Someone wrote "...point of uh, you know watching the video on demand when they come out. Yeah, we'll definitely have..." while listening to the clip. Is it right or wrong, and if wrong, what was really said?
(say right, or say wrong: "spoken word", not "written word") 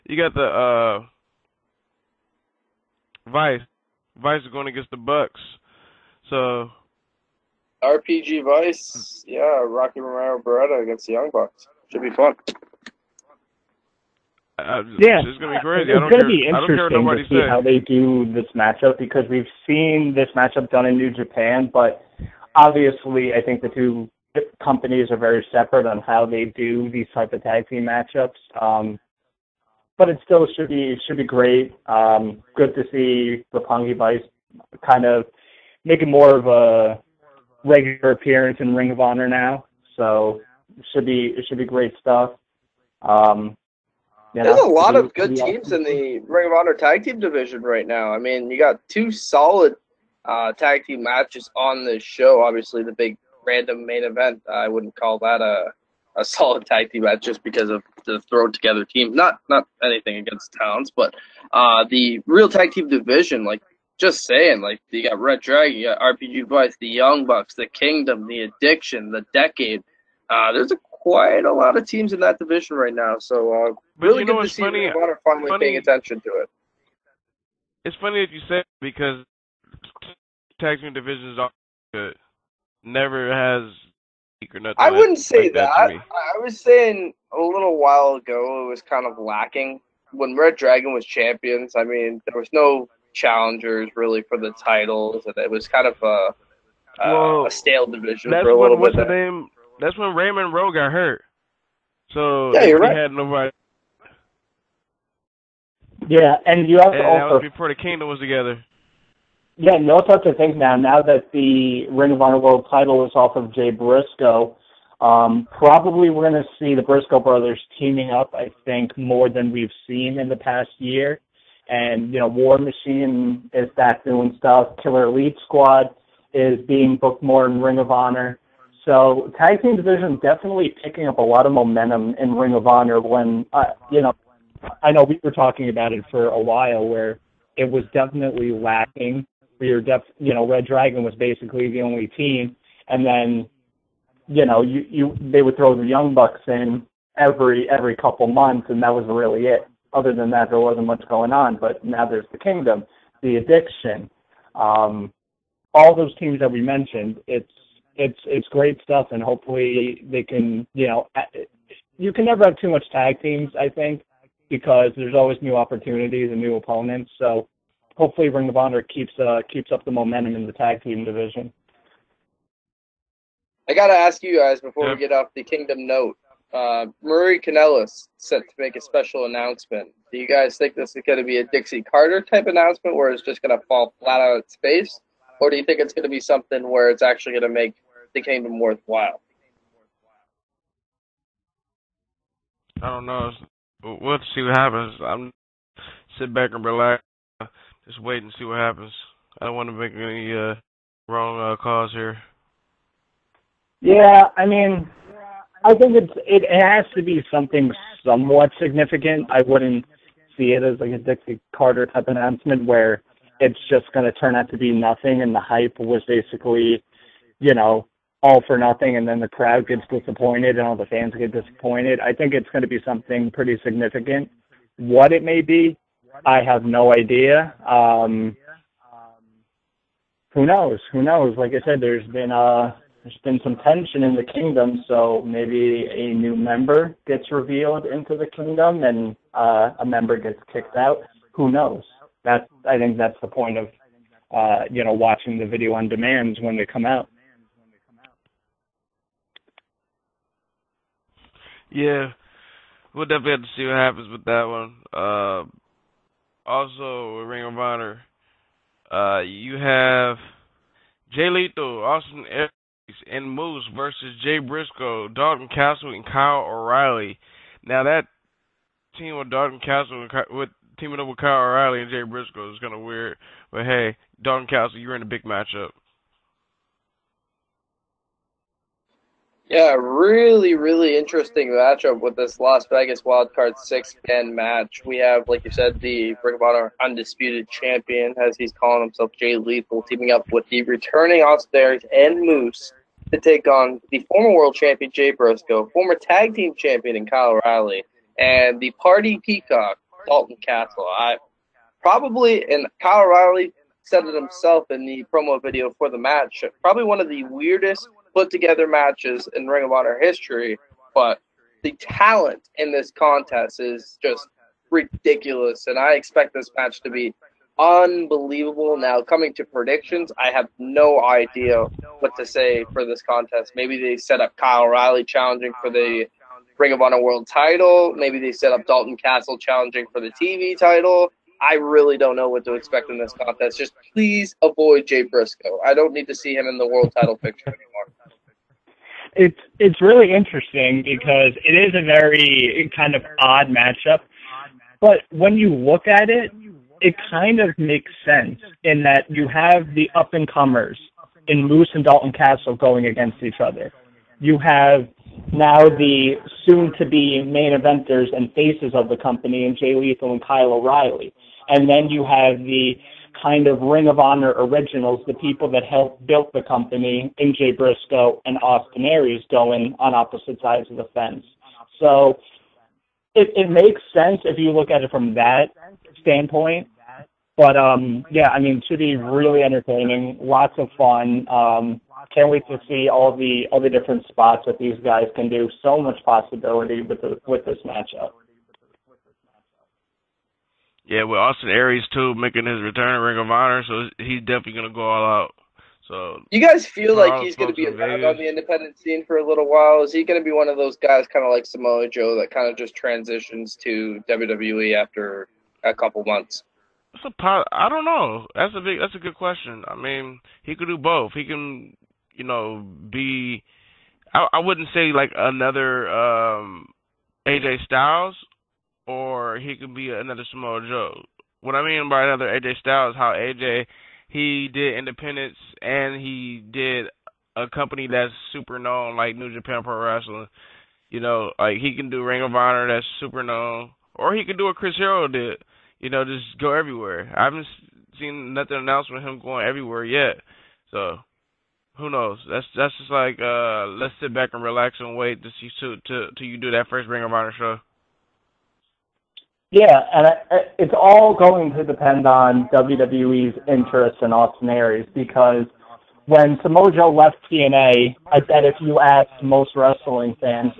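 right.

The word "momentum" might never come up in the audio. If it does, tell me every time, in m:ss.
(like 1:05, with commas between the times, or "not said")
2:11, 2:49.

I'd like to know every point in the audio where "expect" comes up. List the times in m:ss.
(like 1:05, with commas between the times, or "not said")
5:15, 5:32.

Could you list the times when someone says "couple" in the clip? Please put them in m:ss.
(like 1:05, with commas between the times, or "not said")
2:27, 6:45.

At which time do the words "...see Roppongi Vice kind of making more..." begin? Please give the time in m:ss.
0:32.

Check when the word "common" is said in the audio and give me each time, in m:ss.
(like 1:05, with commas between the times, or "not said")
not said.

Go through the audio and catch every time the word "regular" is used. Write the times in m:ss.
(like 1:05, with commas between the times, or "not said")
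0:37.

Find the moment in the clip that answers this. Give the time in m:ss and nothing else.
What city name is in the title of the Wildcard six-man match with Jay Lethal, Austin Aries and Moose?
4:42.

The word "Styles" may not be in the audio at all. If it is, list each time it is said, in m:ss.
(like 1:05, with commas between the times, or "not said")
6:57, 7:02.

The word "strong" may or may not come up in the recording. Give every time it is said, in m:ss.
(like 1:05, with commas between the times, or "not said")
not said.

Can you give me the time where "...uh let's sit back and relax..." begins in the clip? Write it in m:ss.
7:23.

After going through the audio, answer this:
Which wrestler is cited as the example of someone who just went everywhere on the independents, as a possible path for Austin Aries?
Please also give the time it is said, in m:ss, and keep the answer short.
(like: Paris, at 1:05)
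Chris Hero, at 7:14.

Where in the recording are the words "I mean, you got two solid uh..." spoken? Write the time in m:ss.
0:48.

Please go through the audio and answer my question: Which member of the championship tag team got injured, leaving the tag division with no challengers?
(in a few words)
Raymond Rowe.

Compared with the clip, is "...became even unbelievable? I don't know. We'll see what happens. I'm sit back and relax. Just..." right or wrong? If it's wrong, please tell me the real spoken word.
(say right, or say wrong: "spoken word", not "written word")
wrong: "worthwhile", not "unbelievable".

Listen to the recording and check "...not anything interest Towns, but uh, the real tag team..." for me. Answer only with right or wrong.
wrong.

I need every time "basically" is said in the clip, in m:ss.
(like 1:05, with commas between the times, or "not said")
2:21, 3:36.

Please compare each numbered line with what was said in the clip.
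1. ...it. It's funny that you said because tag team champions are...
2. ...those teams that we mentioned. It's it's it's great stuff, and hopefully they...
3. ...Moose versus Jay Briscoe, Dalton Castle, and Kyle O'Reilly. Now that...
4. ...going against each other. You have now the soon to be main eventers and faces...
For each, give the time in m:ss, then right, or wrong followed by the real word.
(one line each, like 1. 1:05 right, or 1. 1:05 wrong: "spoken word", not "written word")
1. 1:16 wrong: "divisions", not "champions"
2. 2:35 right
3. 4:23 right
4. 5:52 right.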